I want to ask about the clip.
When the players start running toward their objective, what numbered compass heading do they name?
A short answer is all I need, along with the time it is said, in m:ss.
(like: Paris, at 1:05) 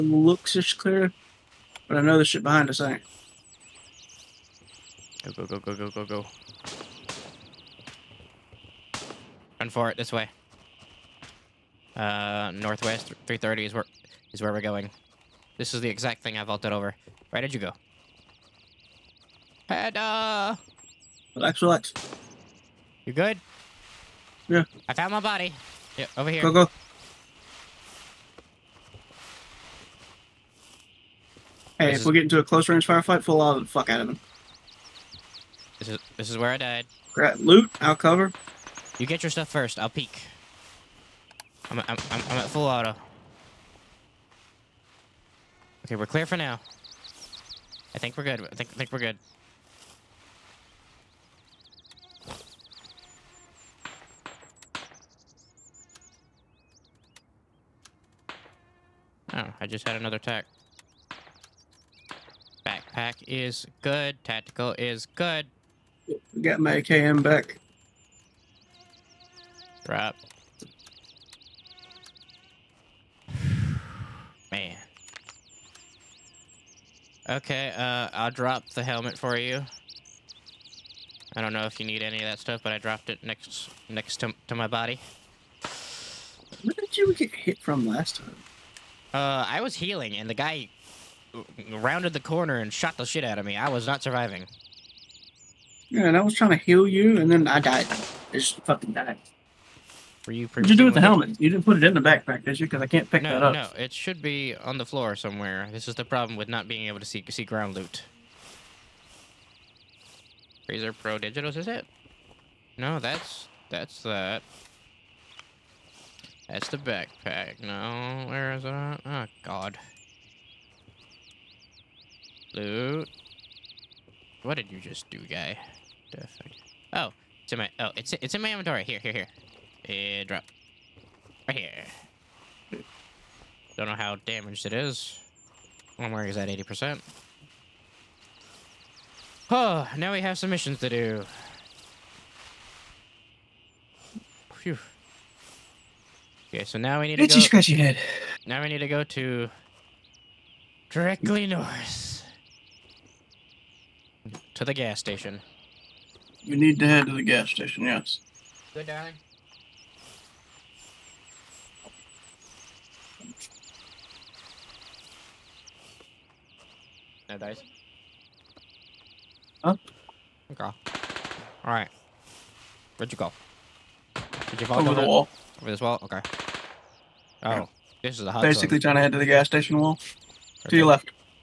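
northwest 330, at 0:12.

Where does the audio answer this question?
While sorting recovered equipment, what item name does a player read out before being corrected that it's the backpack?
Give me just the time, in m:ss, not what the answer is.
1:50.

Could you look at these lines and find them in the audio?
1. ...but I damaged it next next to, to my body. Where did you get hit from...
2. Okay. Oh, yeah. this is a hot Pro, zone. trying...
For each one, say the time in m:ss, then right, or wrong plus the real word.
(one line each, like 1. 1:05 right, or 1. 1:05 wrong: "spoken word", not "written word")
1. 1:22 wrong: "dropped", not "damaged"
2. 2:56 wrong: "Basically", not "Pro".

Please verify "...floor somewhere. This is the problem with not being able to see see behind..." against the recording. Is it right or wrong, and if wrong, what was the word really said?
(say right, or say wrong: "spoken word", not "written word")
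wrong: "ground", not "behind".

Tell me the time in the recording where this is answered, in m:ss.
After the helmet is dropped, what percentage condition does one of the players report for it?
2:16.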